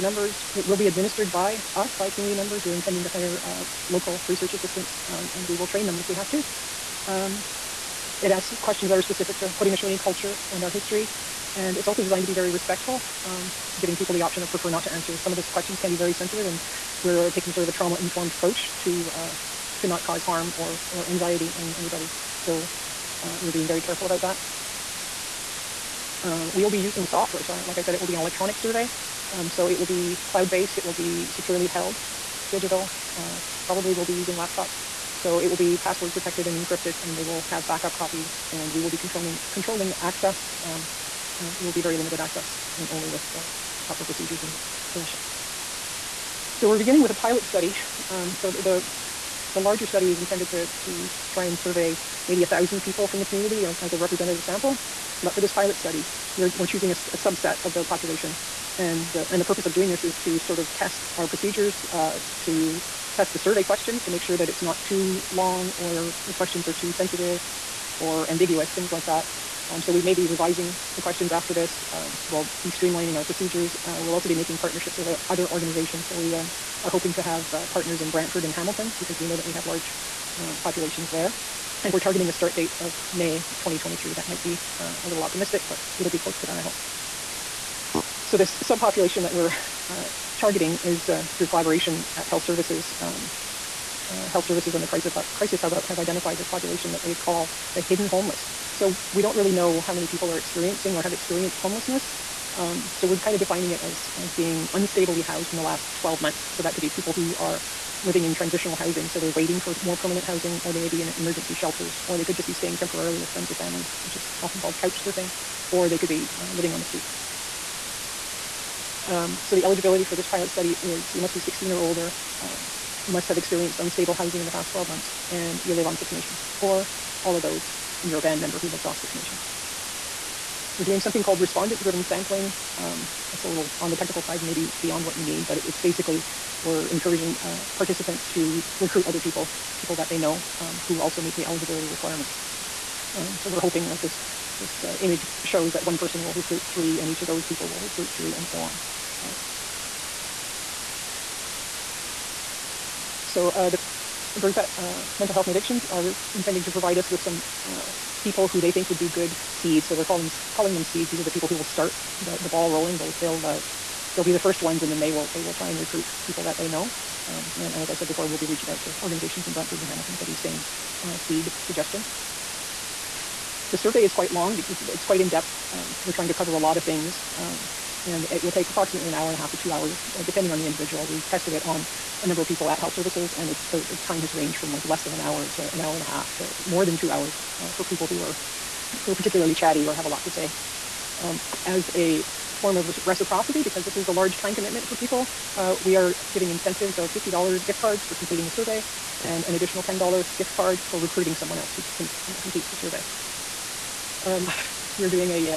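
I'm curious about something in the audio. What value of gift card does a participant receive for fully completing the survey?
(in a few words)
$50.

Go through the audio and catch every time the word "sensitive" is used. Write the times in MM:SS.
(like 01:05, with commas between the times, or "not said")
00:16, 01:06.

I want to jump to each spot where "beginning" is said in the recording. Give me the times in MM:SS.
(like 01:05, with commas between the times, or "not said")
00:46.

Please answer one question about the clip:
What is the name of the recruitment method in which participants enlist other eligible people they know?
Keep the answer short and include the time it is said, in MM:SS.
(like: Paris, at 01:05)
respondent driven sampling, at 02:11.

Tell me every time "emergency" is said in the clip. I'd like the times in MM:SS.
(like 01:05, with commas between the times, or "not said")
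01:51.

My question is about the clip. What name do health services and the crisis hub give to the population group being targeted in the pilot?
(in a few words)
hidden homeless.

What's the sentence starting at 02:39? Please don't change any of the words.
So we're calling calling them seeds.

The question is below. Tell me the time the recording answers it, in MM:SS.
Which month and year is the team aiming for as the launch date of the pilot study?
01:23.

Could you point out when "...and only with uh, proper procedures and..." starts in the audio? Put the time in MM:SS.
00:42.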